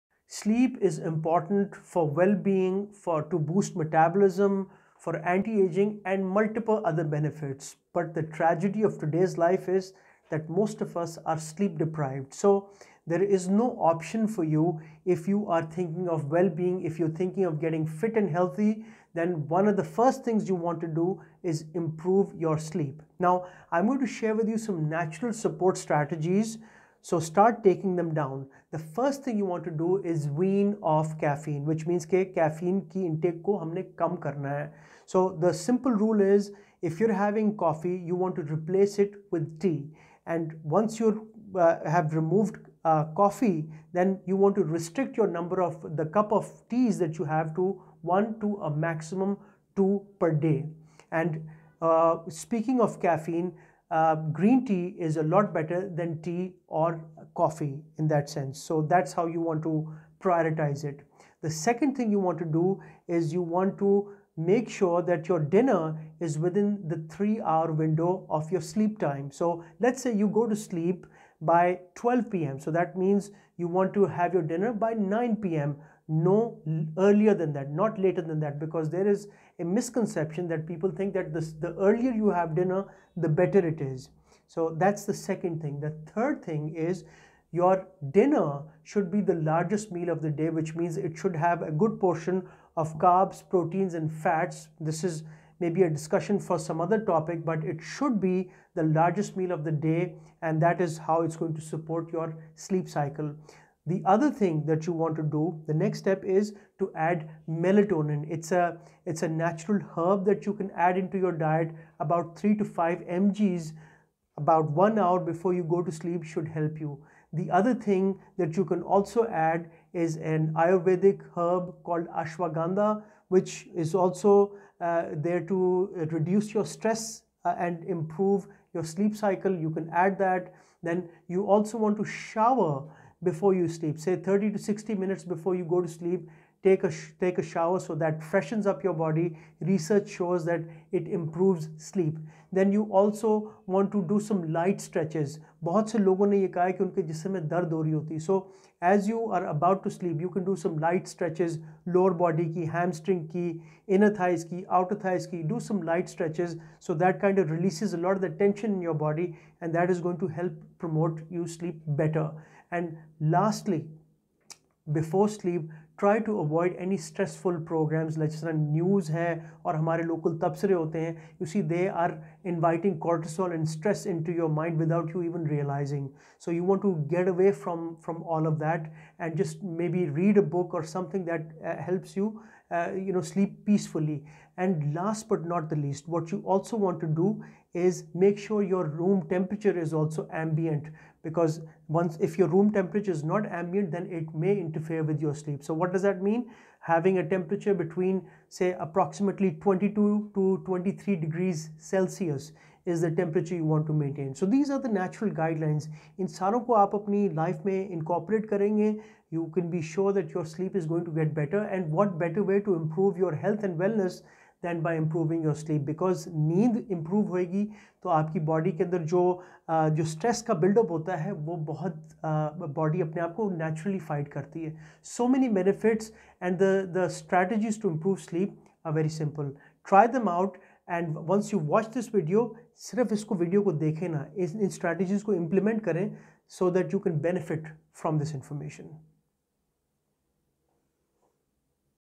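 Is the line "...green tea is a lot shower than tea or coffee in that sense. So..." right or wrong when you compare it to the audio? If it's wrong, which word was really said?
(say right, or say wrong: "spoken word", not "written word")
wrong: "better", not "shower".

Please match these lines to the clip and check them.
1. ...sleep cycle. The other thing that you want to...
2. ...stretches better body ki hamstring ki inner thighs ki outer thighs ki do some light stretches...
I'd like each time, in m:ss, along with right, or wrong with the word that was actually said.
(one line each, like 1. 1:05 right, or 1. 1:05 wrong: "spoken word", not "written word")
1. 1:42 right
2. 2:31 wrong: "lower", not "better".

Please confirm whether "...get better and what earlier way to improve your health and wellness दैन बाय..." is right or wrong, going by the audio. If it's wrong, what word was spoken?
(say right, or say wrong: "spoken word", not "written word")
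wrong: "better", not "earlier".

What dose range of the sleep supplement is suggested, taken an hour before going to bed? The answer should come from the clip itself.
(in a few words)
3 to 5 mg.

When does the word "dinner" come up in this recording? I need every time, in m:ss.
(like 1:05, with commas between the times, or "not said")
1:05, 1:14, 1:22, 1:28.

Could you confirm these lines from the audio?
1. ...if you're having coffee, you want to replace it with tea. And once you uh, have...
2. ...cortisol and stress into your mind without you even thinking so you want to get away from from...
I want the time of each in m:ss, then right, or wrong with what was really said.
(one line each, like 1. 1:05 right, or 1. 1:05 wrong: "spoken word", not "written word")
1. 0:36 right
2. 2:53 wrong: "realizing", not "thinking".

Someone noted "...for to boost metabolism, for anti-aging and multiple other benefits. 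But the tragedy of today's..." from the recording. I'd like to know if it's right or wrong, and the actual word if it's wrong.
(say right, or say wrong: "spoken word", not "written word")
right.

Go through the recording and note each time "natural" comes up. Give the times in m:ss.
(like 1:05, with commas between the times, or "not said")
0:24, 1:49, 3:24.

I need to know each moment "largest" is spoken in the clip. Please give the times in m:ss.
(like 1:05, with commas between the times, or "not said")
1:29, 1:38.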